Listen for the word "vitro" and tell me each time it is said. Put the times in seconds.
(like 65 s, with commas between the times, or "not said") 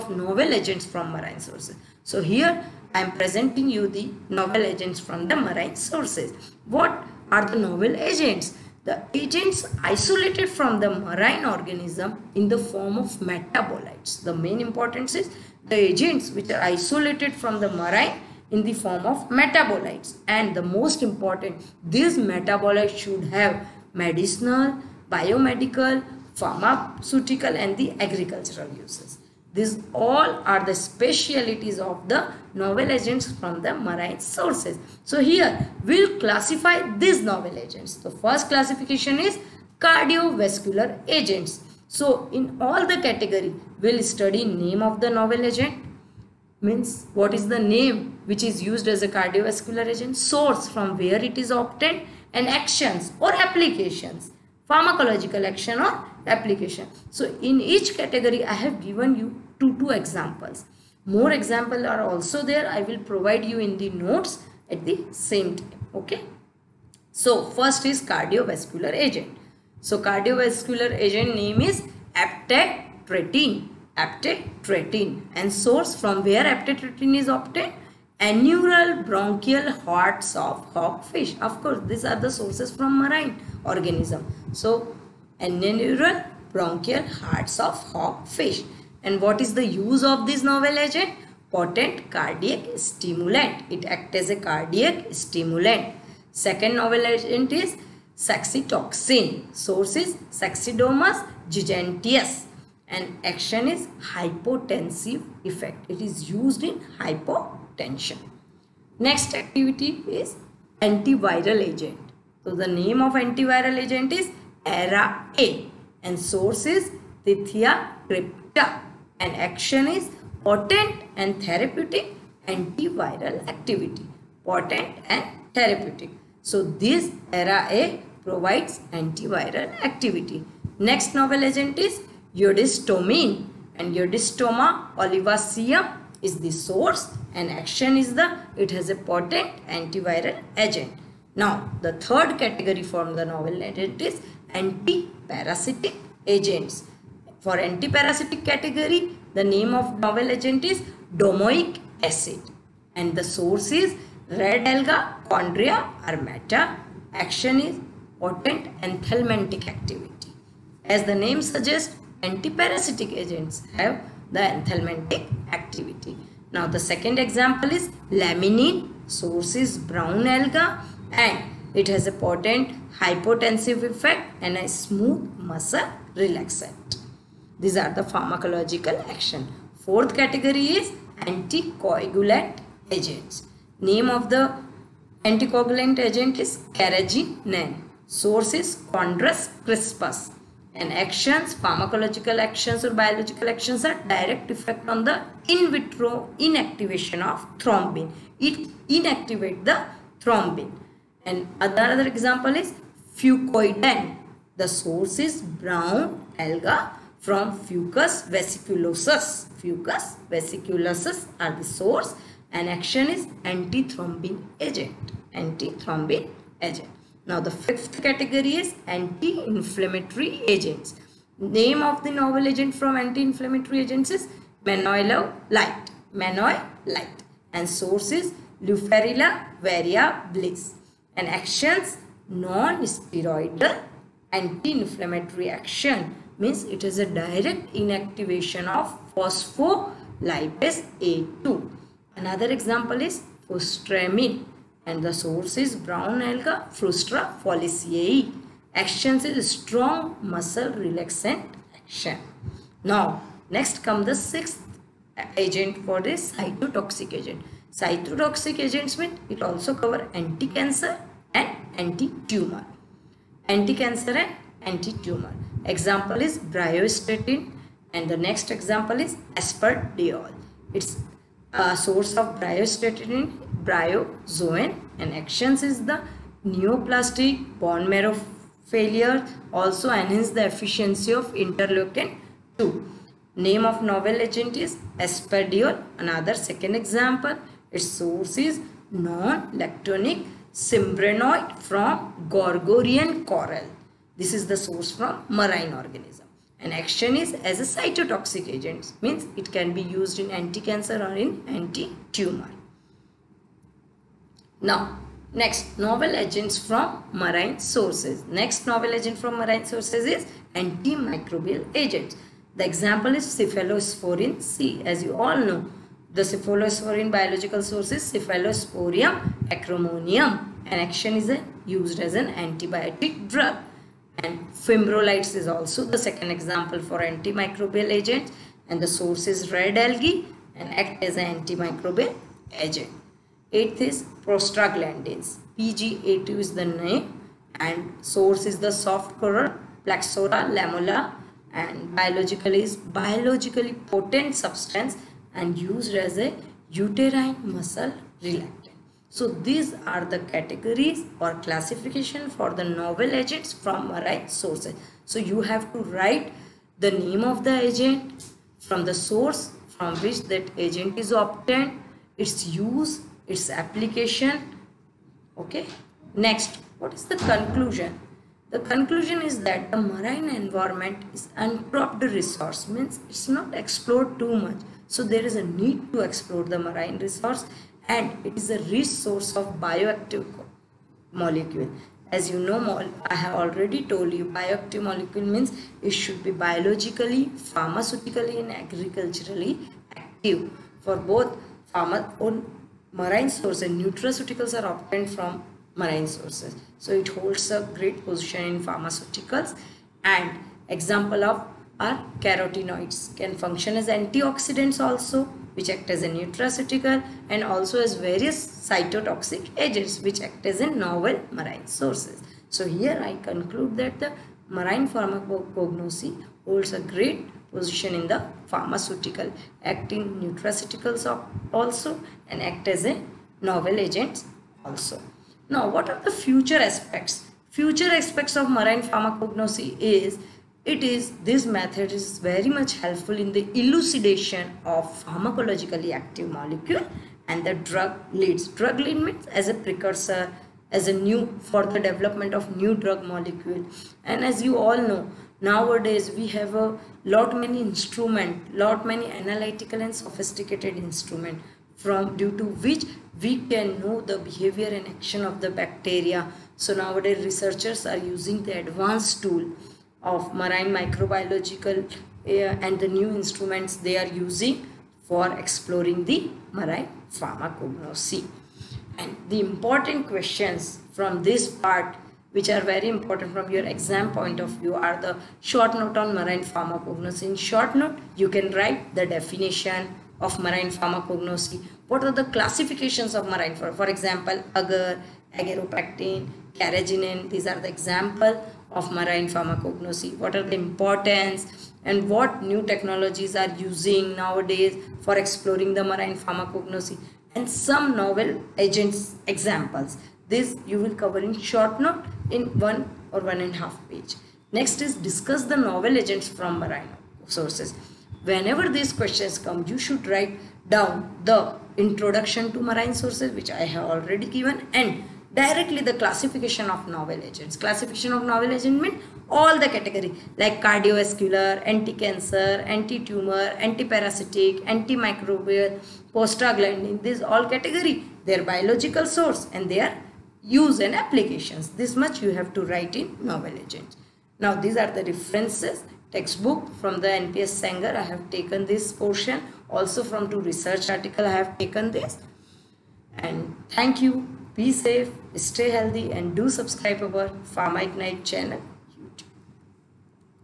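195 s.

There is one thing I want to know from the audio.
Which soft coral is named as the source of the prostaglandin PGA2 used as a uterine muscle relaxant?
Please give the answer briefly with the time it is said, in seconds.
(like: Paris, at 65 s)
Plexaura lamella, at 339 s.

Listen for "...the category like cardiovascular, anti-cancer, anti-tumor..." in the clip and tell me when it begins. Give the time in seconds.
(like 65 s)
519 s.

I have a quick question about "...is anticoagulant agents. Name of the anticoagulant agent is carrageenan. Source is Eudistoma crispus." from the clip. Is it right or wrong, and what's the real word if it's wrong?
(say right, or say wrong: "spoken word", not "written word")
wrong: "Chondrus", not "Eudistoma".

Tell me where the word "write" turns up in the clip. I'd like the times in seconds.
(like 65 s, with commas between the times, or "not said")
355 s, 478 s, 510 s, 532 s.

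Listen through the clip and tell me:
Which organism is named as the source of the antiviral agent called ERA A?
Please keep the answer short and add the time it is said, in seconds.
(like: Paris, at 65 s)
Tethya crypta, at 117 s.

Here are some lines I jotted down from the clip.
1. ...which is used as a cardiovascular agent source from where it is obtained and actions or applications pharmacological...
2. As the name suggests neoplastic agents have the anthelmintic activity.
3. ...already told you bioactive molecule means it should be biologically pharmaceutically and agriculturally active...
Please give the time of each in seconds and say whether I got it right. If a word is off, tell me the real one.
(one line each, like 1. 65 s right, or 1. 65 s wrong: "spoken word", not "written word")
1. 48 s right
2. 160 s wrong: "antiparasitic", not "neoplastic"
3. 383 s right.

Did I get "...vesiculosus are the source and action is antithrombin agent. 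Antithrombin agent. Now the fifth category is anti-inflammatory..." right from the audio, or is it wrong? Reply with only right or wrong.
right.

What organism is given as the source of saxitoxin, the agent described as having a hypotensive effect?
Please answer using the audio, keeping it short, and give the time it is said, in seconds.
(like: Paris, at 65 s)
Saxidomus giganteus, at 100 s.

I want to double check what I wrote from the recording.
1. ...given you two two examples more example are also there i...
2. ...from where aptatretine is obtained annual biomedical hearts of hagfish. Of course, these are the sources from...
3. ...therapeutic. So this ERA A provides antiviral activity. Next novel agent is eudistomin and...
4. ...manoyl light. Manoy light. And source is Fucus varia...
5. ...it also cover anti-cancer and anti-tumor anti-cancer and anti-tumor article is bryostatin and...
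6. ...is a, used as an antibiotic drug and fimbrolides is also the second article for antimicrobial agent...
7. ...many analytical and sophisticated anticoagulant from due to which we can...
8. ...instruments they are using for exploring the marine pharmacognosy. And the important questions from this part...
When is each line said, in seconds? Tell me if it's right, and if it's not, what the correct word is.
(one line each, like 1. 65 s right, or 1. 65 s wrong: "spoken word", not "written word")
1. 58 s right
2. 76 s wrong: "bronchial", not "biomedical"
3. 125 s right
4. 224 s wrong: "Leuferilla", not "Fucus"
5. 259 s wrong: "example", not "article"
6. 321 s wrong: "example", not "article"
7. 448 s wrong: "instrument", not "anticoagulant"
8. 463 s right.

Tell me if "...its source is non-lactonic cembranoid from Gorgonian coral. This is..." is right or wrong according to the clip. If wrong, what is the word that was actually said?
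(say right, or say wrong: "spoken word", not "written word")
right.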